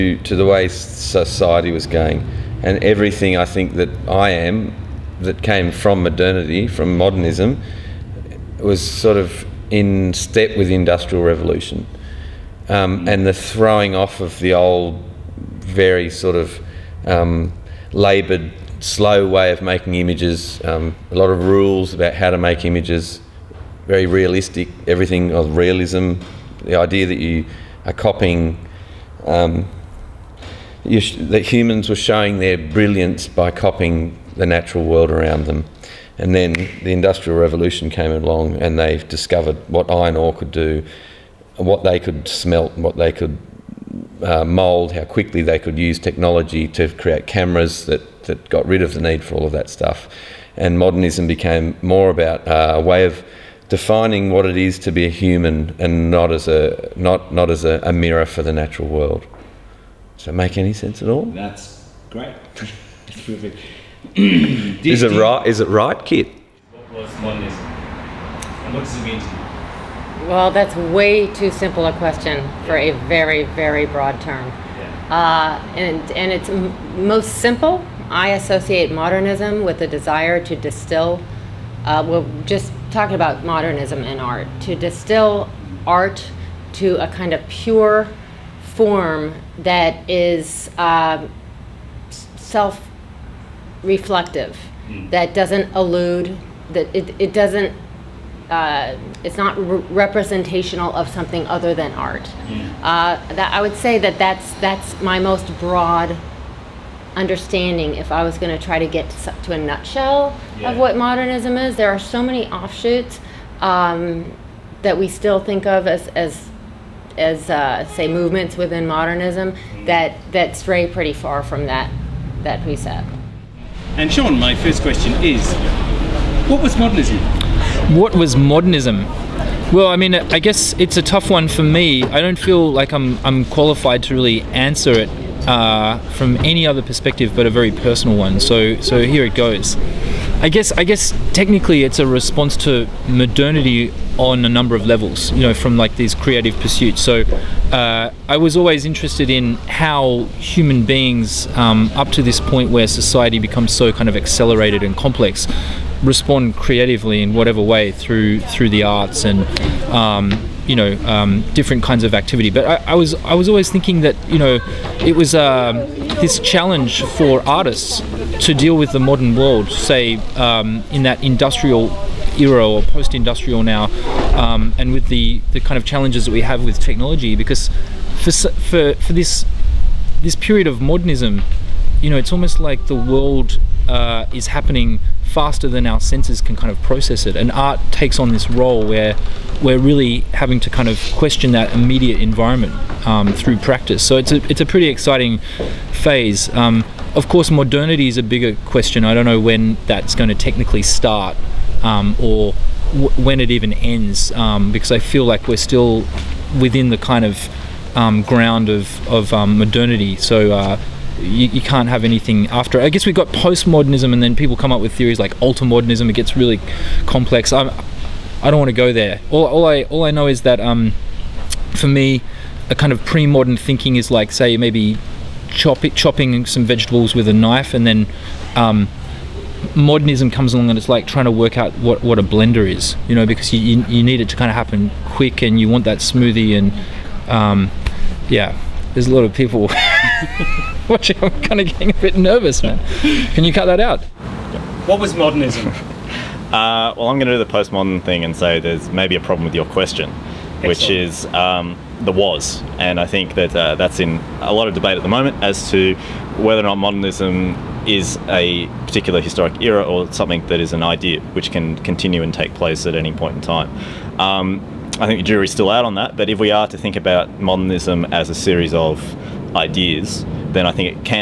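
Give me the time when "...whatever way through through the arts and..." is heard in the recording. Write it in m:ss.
2:37.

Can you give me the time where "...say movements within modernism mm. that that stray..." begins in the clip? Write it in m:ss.
1:57.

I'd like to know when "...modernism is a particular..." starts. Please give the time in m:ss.
4:16.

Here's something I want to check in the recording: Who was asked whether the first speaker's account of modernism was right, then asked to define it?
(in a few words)
Kit.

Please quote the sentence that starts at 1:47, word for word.
If I was going to try to get to a nutshell yeah.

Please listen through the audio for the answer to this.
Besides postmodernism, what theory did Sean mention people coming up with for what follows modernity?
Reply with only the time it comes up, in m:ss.
3:35.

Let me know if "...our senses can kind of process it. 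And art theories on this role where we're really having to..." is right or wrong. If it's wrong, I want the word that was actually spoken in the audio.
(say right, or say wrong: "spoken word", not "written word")
wrong: "takes", not "theories".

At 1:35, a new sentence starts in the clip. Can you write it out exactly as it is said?
that doesn't elude, that it, it doesn't uh, it's not re representational of something other than art.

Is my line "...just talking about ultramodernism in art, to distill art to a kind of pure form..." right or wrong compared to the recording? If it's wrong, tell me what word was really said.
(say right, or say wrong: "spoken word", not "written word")
wrong: "modernism", not "ultramodernism".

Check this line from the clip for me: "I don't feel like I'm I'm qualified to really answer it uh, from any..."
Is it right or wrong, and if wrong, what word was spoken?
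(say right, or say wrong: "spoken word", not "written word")
right.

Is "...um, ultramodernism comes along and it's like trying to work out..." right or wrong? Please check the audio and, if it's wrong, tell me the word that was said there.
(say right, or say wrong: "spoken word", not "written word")
wrong: "modernism", not "ultramodernism".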